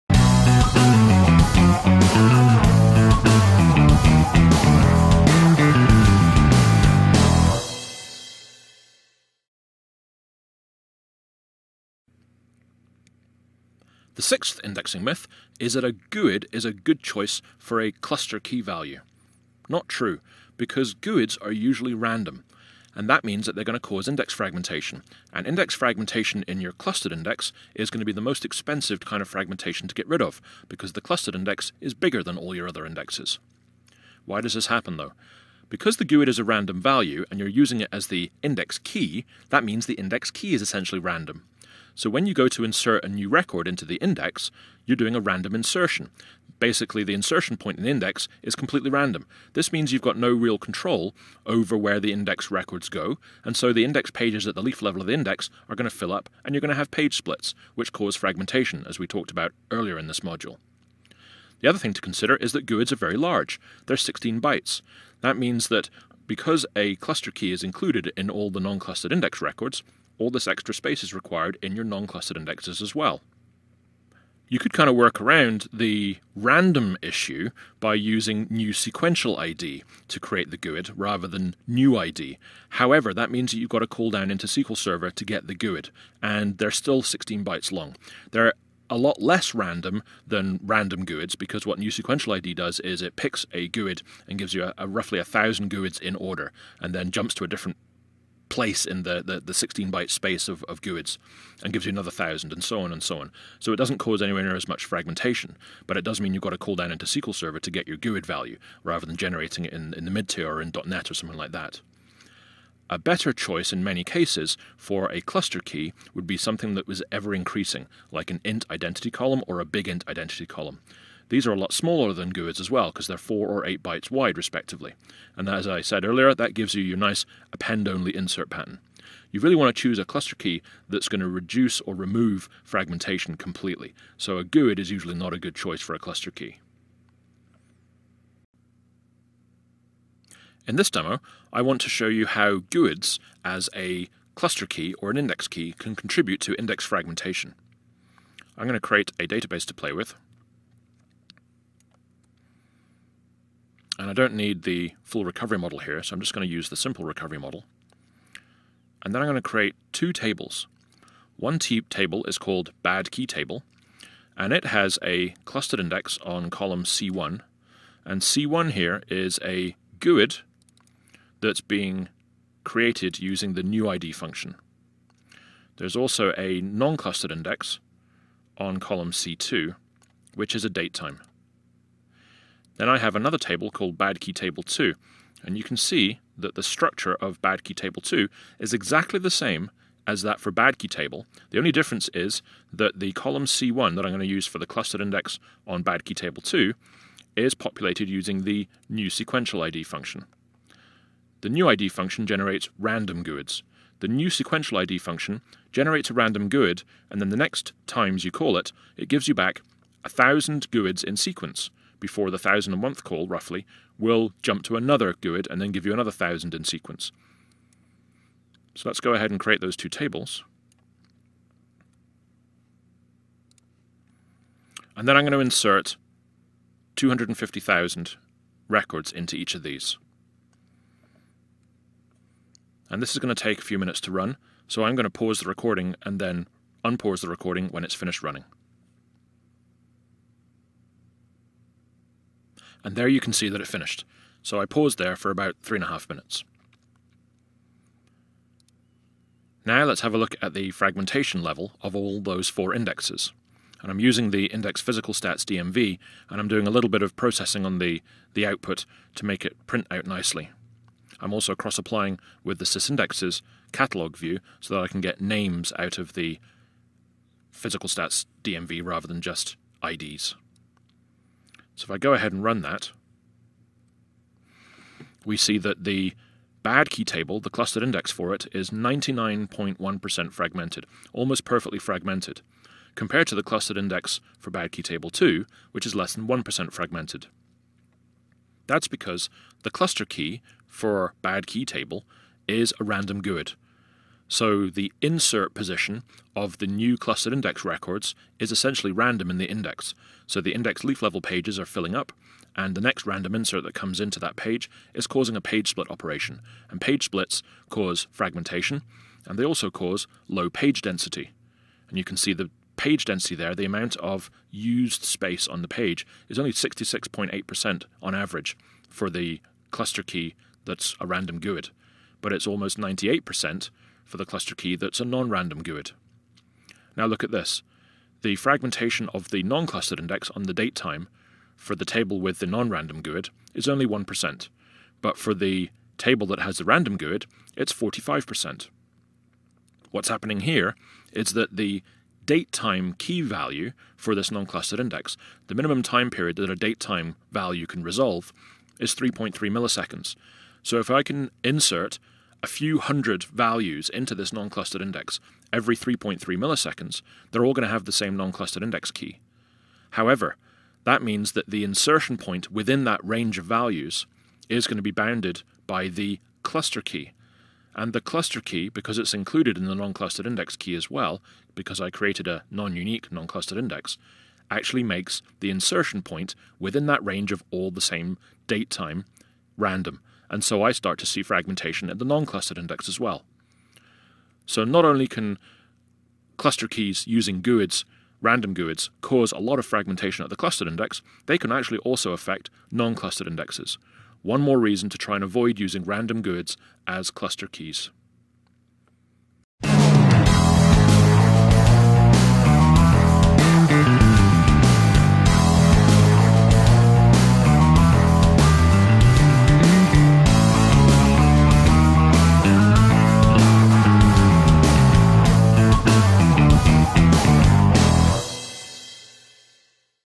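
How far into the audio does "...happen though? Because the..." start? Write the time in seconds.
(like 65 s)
34 s.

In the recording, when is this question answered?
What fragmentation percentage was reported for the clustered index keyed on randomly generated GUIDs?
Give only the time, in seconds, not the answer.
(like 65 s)
278 s.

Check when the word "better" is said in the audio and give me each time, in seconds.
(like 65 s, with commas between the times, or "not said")
112 s.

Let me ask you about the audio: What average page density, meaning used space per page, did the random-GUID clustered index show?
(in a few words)
66.8%.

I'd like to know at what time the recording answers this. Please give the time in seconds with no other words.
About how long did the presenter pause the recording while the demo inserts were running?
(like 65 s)
245 s.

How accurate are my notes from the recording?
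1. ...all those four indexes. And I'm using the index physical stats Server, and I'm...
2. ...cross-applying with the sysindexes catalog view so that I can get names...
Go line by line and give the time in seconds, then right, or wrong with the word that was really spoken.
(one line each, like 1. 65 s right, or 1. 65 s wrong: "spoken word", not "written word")
1. 251 s wrong: "DMV", not "Server"
2. 261 s right.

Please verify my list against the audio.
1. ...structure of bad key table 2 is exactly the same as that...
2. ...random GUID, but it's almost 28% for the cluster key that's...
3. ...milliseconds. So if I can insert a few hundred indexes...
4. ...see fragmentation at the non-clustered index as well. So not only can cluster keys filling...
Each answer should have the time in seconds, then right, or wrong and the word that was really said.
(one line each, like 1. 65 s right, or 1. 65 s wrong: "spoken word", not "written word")
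1. 186 s right
2. 321 s wrong: "98", not "28"
3. 349 s wrong: "values", not "indexes"
4. 381 s wrong: "using", not "filling".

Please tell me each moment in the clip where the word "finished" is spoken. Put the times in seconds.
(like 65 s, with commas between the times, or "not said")
237 s, 243 s.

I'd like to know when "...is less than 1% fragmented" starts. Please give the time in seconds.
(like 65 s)
285 s.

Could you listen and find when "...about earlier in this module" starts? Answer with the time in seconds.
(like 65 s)
59 s.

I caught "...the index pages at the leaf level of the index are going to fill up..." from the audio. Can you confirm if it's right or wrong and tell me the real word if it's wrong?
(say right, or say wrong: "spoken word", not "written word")
right.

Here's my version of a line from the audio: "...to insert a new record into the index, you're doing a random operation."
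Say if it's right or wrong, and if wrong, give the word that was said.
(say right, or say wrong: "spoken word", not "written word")
wrong: "insertion", not "operation".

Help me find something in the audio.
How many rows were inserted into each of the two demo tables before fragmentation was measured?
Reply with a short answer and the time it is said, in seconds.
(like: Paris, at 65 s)
250,000, at 226 s.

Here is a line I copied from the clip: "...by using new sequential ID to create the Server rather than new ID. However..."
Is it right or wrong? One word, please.
wrong.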